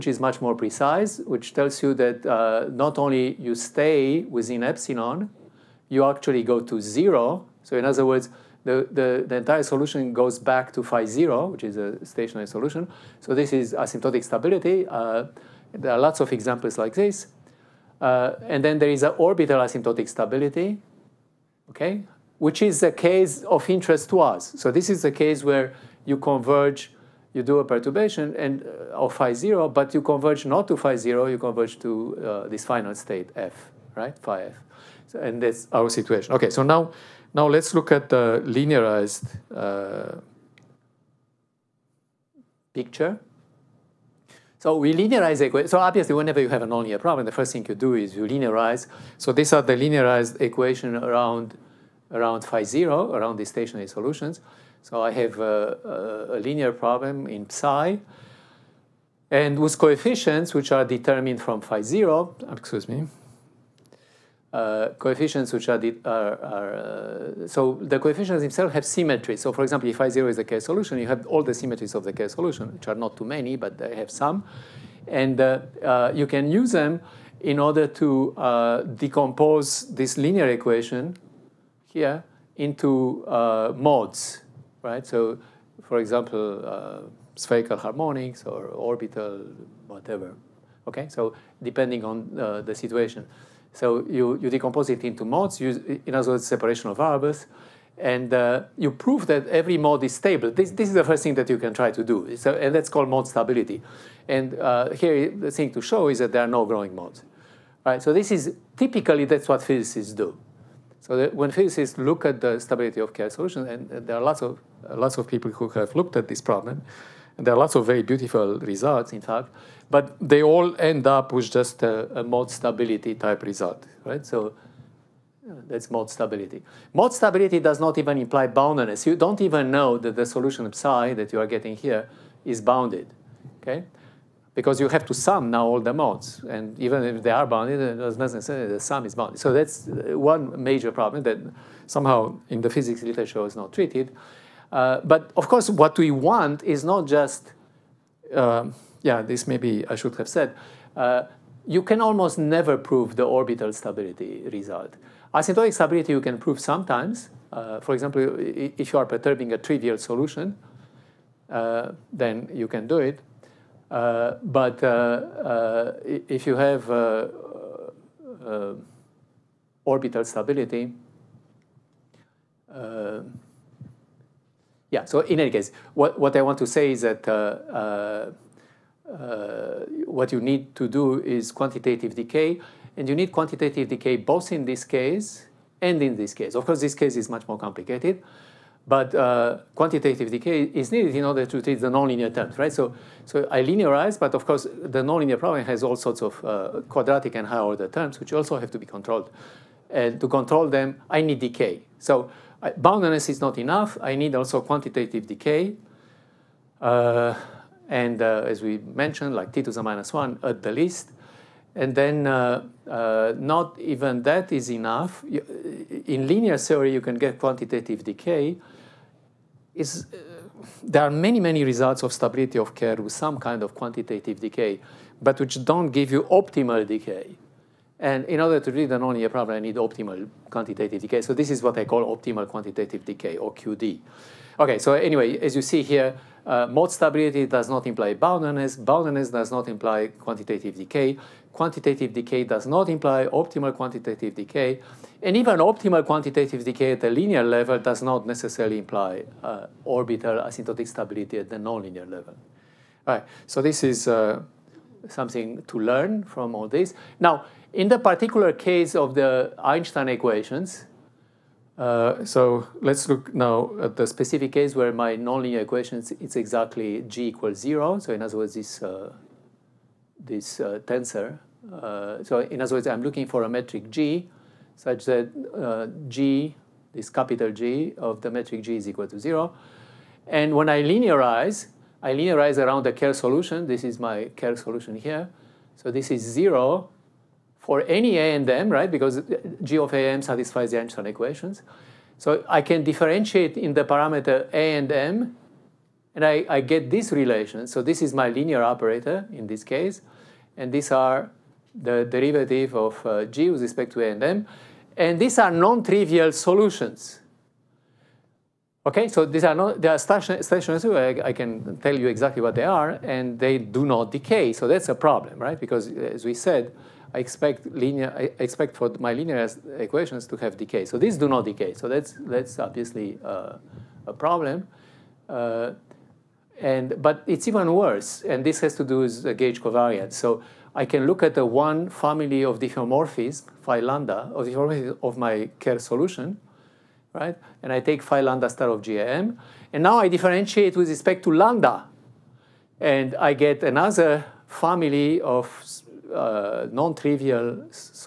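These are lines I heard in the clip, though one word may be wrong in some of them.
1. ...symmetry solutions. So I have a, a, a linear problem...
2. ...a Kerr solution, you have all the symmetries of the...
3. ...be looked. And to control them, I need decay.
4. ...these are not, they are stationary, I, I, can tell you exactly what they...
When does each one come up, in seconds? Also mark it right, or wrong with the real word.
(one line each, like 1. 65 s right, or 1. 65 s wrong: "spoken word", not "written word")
1. 53 s wrong: "stationary", not "symmetry"
2. 70 s right
3. 198 s wrong: "controlled", not "looked"
4. 309 s right.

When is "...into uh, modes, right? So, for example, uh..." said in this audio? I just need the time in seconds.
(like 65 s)
82 s.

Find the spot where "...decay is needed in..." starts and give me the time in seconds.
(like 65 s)
190 s.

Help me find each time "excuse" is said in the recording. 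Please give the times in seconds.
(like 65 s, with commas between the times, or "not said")
62 s.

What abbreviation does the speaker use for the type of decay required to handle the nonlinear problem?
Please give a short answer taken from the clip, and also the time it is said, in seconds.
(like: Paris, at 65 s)
QD, at 233 s.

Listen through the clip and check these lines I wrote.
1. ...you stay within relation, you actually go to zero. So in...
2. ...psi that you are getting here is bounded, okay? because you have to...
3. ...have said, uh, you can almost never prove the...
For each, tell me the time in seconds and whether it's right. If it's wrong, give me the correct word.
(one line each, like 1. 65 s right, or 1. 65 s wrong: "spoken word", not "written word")
1. 3 s wrong: "epsilon", not "relation"
2. 130 s right
3. 150 s right.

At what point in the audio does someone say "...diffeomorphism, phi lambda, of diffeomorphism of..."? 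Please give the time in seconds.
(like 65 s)
332 s.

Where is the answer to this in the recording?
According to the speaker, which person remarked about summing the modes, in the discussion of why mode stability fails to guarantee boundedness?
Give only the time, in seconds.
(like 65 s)
138 s.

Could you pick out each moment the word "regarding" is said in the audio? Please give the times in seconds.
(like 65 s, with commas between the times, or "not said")
not said.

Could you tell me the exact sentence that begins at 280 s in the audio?
And when I linearize, I linearize around the Kerr solution.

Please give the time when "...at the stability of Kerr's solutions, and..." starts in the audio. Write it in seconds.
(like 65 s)
112 s.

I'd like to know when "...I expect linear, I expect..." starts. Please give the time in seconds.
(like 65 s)
317 s.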